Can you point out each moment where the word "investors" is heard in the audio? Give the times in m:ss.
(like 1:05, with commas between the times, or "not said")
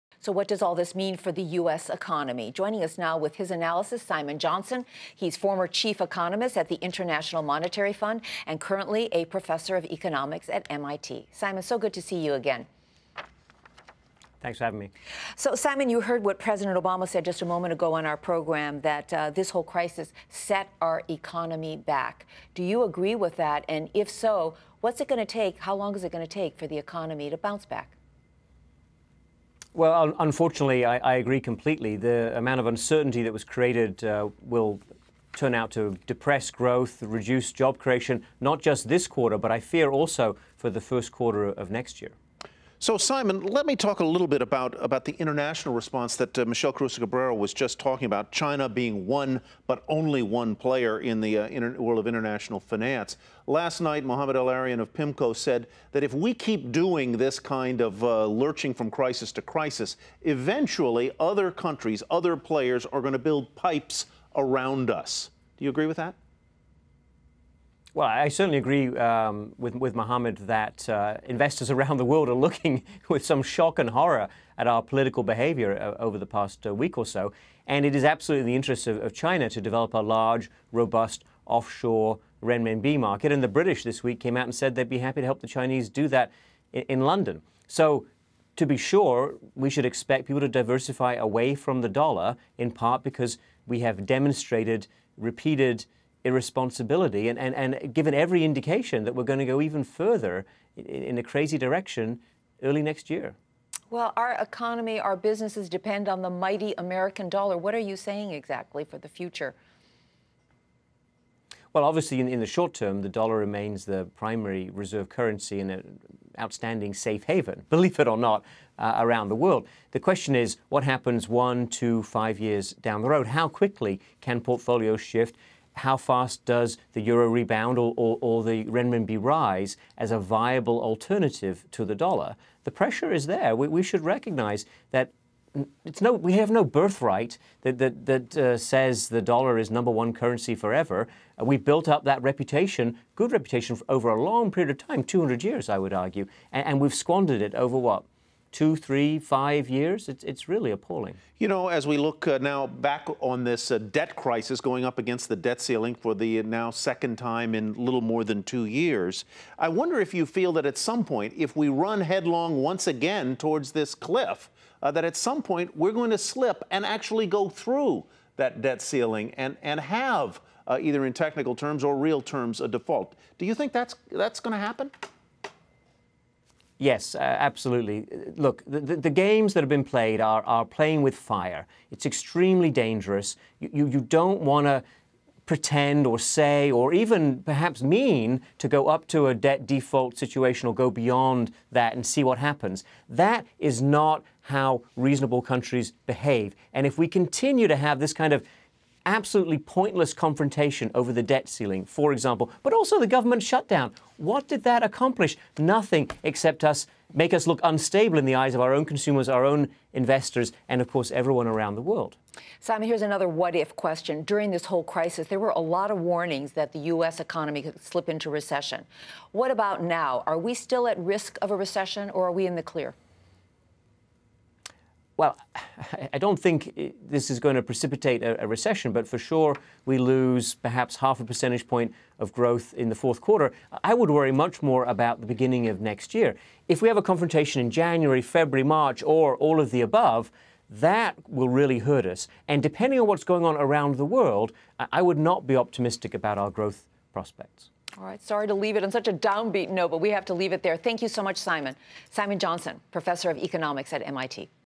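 1:11, 3:29.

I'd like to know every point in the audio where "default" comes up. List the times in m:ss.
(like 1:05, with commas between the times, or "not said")
2:52, 3:09.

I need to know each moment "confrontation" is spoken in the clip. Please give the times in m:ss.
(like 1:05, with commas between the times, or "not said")
3:20, 3:57.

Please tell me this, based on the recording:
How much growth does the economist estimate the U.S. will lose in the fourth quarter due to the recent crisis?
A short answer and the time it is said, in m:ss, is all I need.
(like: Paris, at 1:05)
half a percentage point, at 3:50.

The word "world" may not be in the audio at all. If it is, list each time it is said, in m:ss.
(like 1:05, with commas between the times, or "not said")
0:51, 1:12, 1:59, 3:31, 4:04.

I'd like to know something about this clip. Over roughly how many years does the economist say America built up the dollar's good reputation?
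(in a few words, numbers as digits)
200 years.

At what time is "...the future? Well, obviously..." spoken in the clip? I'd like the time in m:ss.
1:48.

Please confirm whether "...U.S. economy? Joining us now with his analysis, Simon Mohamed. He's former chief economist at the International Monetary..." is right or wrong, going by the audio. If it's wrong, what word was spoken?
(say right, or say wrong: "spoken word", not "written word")
wrong: "Johnson", not "Mohamed".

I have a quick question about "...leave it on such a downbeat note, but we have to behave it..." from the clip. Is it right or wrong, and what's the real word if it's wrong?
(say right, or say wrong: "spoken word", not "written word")
wrong: "leave", not "behave".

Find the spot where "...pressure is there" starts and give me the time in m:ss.
2:12.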